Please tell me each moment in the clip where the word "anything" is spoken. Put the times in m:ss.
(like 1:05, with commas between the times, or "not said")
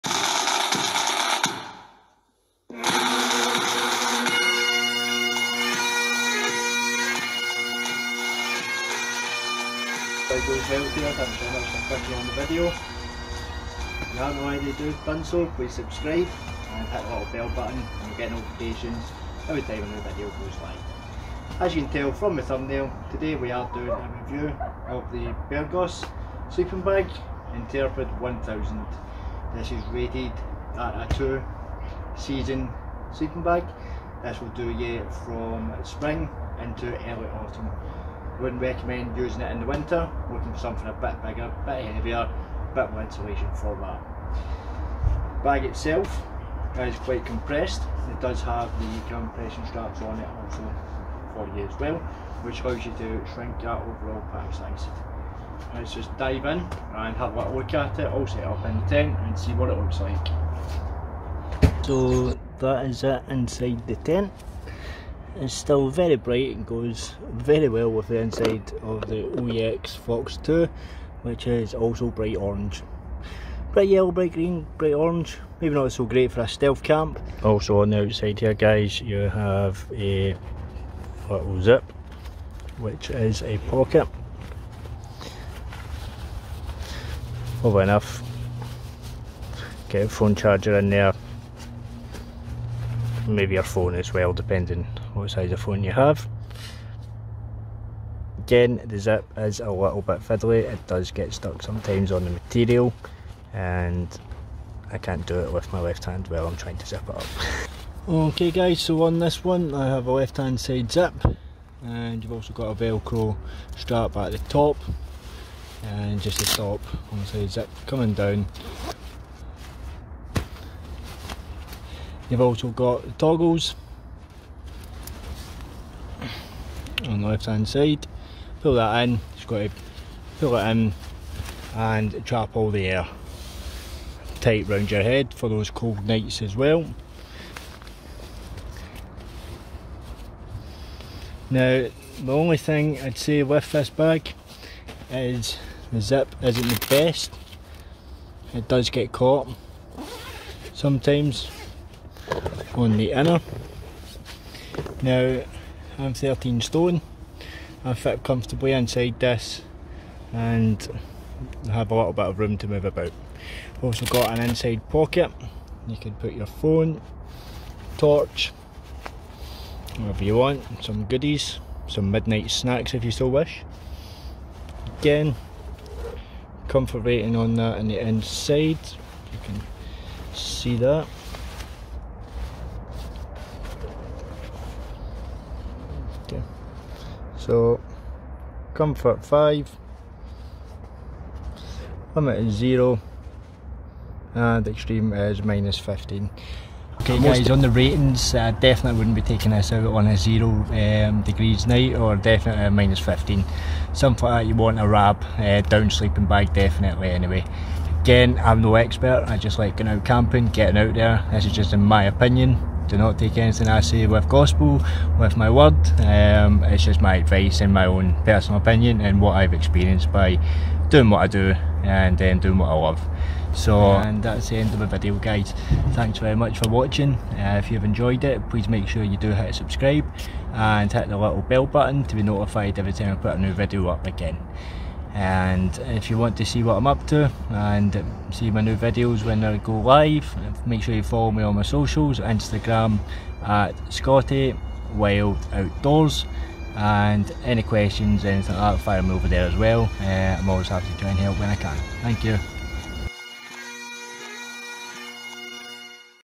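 3:33, 4:08.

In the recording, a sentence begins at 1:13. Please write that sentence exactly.
Bright yellow, bright green, bright orange, maybe not so great for a stealth camp.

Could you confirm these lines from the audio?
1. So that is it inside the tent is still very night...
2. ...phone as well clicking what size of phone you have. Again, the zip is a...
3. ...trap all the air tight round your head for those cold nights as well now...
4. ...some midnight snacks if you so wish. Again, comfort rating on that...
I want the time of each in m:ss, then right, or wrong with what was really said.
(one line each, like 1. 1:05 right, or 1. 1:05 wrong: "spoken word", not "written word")
1. 1:01 wrong: "bright", not "night"
2. 1:33 wrong: "depending", not "clicking"
3. 2:12 right
4. 2:51 right.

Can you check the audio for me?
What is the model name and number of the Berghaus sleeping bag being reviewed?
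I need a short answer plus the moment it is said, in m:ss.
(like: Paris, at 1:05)
Intrepid 1000, at 0:27.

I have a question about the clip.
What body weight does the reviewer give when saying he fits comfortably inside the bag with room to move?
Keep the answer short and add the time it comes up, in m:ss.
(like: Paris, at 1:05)
13 stone, at 2:36.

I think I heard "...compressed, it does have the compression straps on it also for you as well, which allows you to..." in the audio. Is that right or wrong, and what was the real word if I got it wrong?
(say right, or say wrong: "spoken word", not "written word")
right.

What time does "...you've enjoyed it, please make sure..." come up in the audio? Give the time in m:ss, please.
3:47.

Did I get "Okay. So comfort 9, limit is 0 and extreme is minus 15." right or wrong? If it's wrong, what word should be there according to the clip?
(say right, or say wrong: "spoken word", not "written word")
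wrong: "5", not "9".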